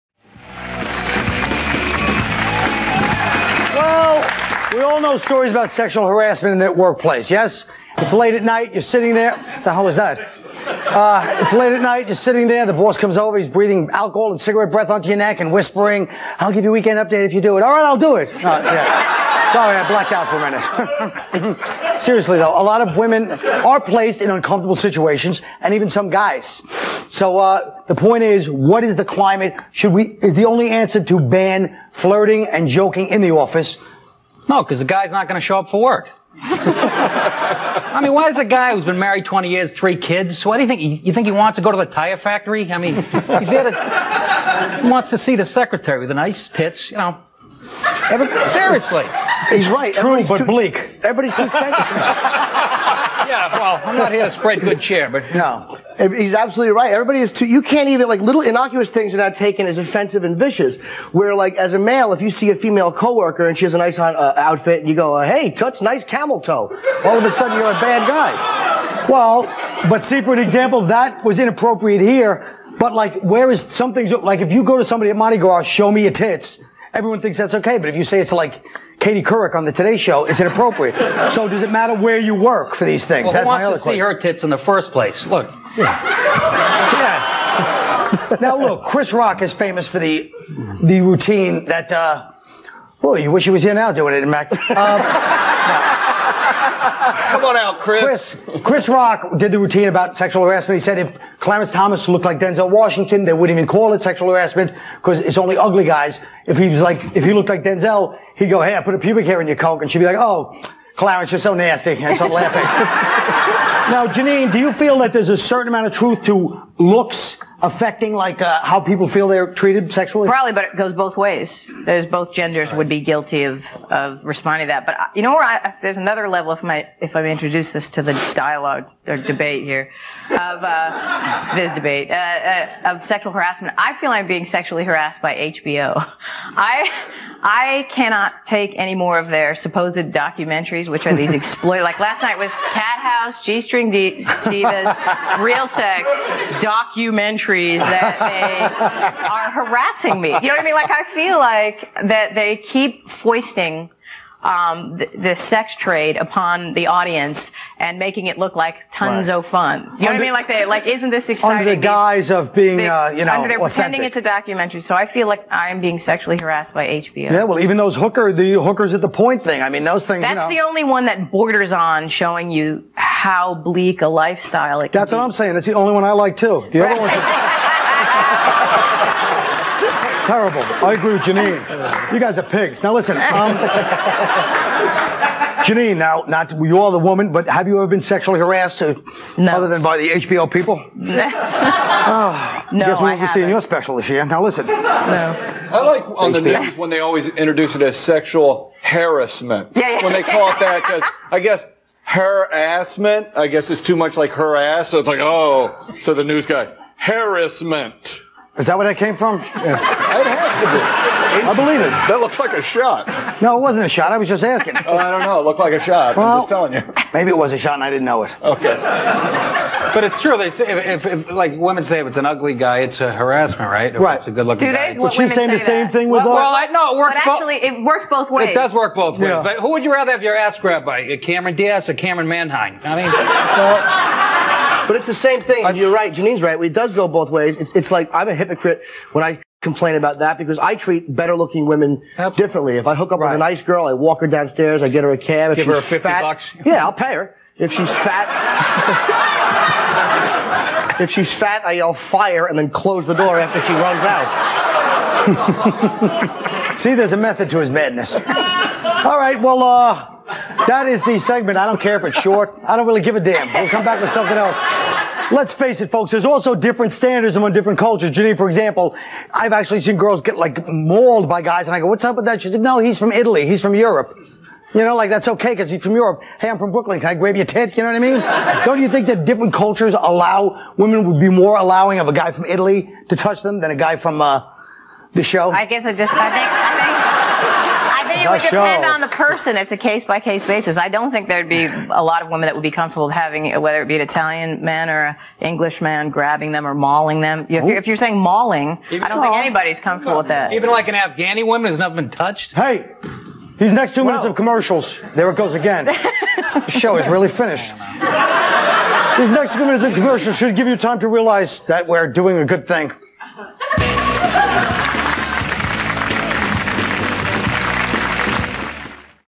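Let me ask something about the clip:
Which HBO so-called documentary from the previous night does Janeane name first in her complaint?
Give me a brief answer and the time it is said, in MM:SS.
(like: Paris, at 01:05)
Cat House, at 02:22.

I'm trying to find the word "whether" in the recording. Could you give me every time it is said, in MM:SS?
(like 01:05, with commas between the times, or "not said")
04:53.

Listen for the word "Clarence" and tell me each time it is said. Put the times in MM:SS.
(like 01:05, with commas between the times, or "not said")
01:41, 01:50.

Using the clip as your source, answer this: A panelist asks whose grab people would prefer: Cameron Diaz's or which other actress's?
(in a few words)
Camryn Manheim.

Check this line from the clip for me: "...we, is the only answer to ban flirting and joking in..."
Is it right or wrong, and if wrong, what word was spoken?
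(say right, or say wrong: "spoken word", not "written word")
right.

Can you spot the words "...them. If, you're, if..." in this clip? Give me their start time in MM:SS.
04:57.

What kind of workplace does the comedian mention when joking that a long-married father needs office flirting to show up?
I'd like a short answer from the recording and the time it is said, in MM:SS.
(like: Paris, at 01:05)
tire factory, at 00:41.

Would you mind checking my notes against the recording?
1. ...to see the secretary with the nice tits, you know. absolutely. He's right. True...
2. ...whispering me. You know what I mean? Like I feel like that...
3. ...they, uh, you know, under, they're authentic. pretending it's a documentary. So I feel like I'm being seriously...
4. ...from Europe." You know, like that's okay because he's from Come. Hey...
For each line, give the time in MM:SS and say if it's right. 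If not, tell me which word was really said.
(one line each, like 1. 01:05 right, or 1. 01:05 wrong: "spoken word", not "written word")
1. 00:45 wrong: "seriously", not "absolutely"
2. 02:29 wrong: "harassing", not "whispering"
3. 02:42 wrong: "sexually", not "seriously"
4. 04:33 wrong: "Europe", not "Come".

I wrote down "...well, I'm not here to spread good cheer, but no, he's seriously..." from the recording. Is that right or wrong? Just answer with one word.
wrong.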